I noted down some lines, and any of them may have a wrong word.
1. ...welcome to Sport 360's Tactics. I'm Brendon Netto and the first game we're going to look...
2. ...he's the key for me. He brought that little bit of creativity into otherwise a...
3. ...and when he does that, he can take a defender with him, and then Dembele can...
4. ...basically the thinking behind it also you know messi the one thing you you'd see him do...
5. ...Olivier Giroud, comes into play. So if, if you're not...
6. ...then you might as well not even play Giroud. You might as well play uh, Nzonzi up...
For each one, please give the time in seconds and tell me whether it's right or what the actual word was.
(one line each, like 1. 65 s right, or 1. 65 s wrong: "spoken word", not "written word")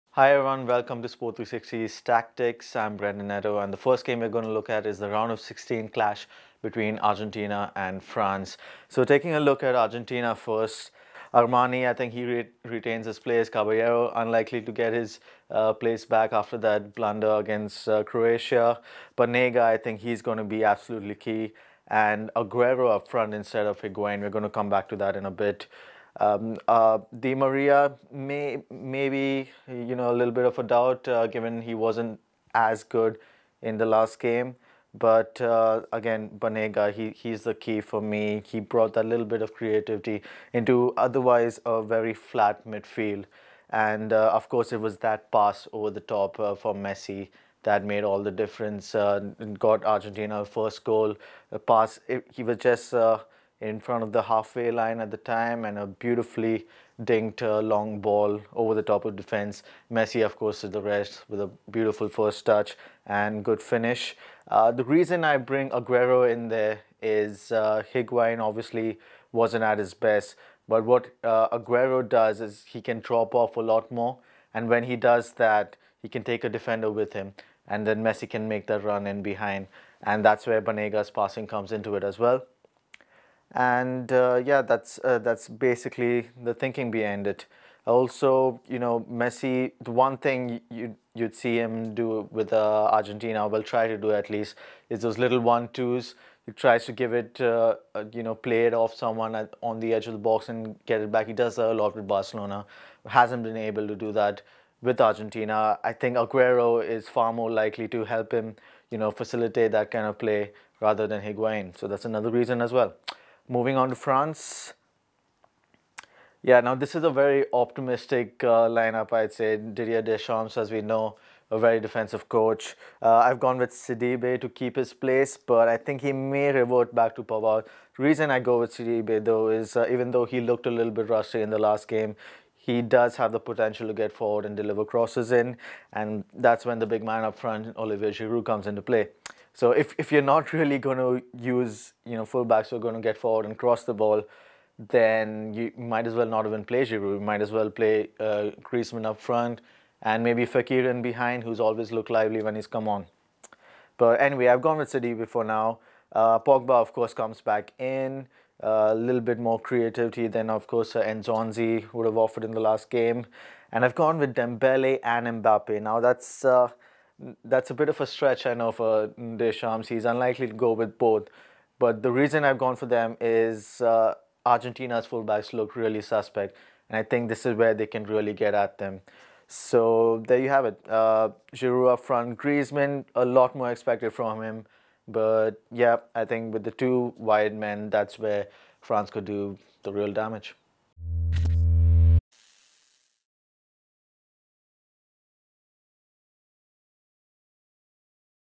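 1. 0 s right
2. 37 s right
3. 74 s wrong: "Messi", not "Dembele"
4. 85 s right
5. 137 s right
6. 144 s wrong: "Griezmann", not "Nzonzi".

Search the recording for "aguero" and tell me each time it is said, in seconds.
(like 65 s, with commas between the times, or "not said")
22 s, 65 s, 71 s, 106 s.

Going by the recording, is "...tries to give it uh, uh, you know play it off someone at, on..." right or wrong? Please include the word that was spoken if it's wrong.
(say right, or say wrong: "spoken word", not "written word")
right.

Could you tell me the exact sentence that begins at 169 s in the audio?
He's unlikely to go with both.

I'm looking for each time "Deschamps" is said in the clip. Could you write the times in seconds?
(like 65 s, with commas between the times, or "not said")
120 s, 169 s.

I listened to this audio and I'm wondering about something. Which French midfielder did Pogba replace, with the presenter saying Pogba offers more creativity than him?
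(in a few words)
Nzonzi.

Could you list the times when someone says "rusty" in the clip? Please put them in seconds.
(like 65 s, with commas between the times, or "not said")
131 s.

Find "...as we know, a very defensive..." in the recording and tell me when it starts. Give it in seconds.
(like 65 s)
120 s.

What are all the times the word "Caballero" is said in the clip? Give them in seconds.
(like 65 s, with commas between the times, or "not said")
13 s.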